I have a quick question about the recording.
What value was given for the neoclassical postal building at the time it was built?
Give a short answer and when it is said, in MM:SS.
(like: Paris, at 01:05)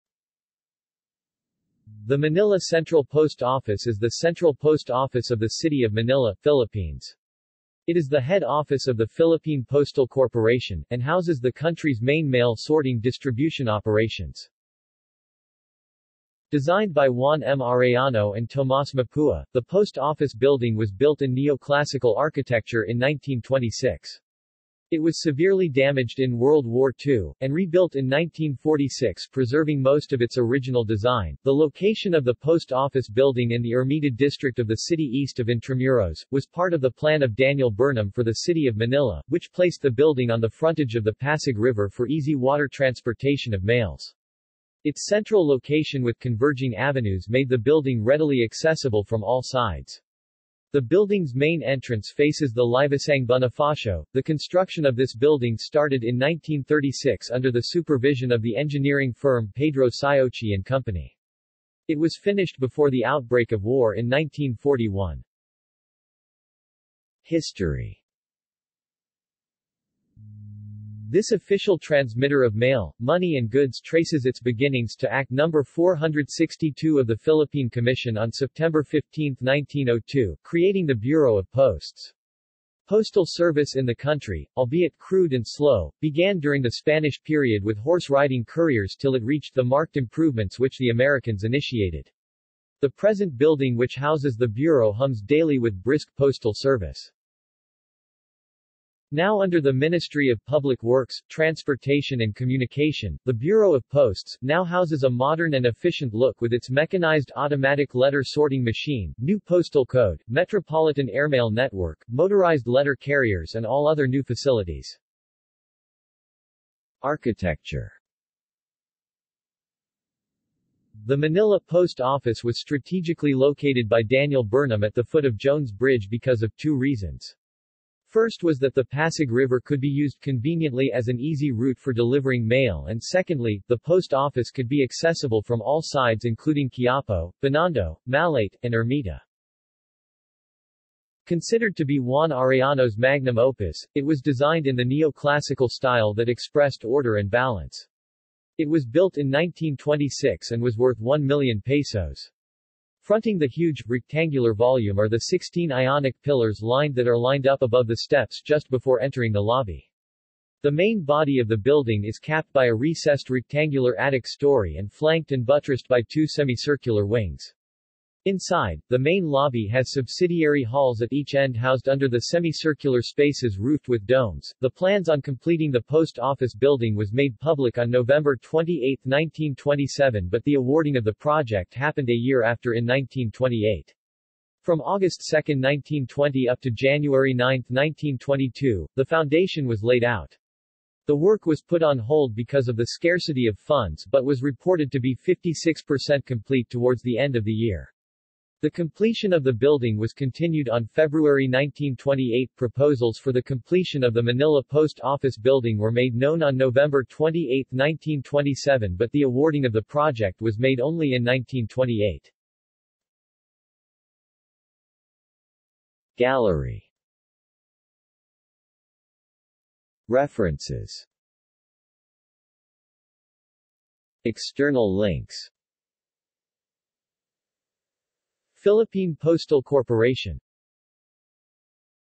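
1 million pesos, at 02:30.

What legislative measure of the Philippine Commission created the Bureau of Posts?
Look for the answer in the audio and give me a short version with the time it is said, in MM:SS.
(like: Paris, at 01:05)
Act No. 462, at 01:15.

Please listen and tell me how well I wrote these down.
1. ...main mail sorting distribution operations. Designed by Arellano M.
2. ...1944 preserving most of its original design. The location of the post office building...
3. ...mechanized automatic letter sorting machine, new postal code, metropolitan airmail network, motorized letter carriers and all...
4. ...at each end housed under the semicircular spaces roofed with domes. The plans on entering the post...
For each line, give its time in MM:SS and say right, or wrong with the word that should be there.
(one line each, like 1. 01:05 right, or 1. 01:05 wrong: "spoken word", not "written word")
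1. 00:12 wrong: "Juan", not "Arellano"
2. 00:28 wrong: "1946", not "1944"
3. 01:46 right
4. 02:51 wrong: "completing", not "entering".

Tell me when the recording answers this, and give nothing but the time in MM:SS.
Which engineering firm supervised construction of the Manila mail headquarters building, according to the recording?
00:59.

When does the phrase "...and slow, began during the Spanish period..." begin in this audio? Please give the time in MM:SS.
01:25.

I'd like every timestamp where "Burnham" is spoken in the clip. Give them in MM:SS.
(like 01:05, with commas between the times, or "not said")
00:37, 02:04.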